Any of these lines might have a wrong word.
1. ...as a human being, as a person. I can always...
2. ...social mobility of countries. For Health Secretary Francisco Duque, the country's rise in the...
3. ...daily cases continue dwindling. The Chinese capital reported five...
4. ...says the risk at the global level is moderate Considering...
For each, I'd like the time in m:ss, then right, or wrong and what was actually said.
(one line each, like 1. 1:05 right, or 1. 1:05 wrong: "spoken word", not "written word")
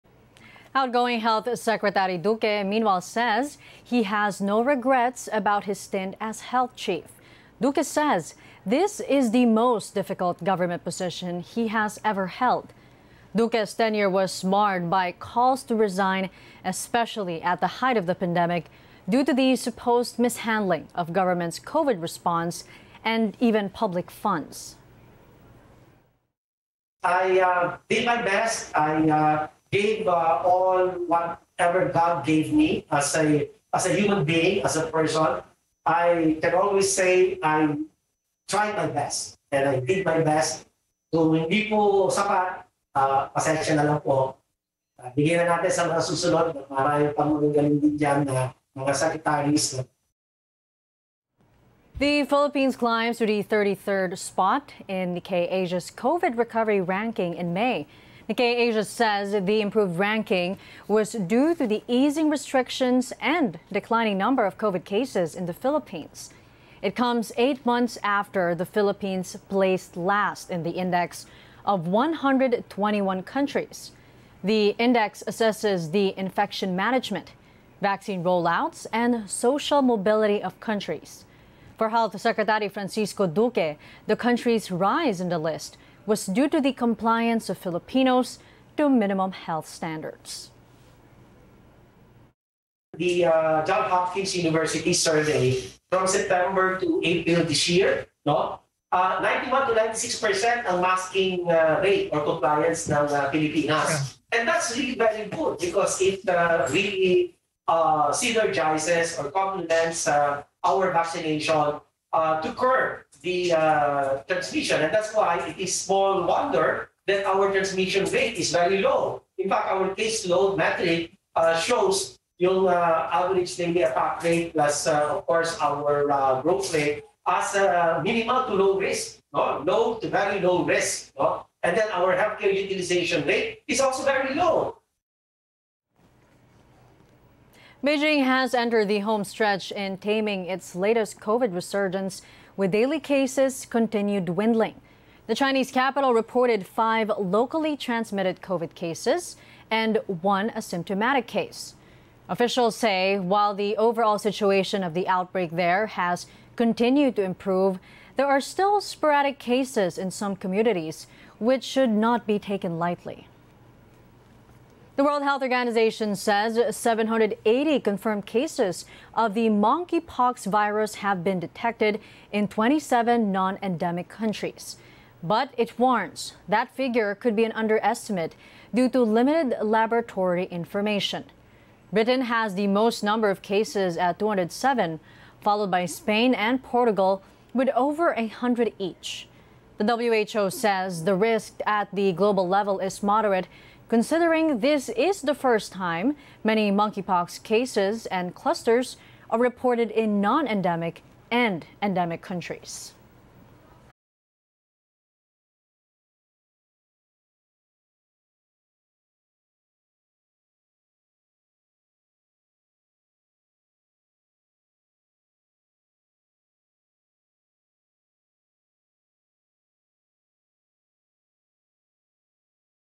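1. 0:33 right
2. 1:19 right
3. 2:22 right
4. 3:10 right.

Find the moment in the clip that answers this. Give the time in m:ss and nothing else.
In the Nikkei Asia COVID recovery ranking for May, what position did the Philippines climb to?
0:53.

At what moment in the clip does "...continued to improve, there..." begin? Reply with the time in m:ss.
2:36.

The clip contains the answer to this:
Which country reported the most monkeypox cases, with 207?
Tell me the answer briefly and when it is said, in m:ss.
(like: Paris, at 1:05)
Britain, at 3:01.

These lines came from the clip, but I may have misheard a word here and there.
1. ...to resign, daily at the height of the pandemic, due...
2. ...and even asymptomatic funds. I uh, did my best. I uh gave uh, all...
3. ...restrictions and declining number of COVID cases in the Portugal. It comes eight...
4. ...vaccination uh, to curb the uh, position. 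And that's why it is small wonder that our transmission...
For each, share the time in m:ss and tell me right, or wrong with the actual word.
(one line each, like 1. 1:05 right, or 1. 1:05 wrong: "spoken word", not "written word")
1. 0:15 wrong: "especially", not "daily"
2. 0:23 wrong: "public", not "asymptomatic"
3. 1:02 wrong: "Philippines", not "Portugal"
4. 1:50 wrong: "transmission", not "position".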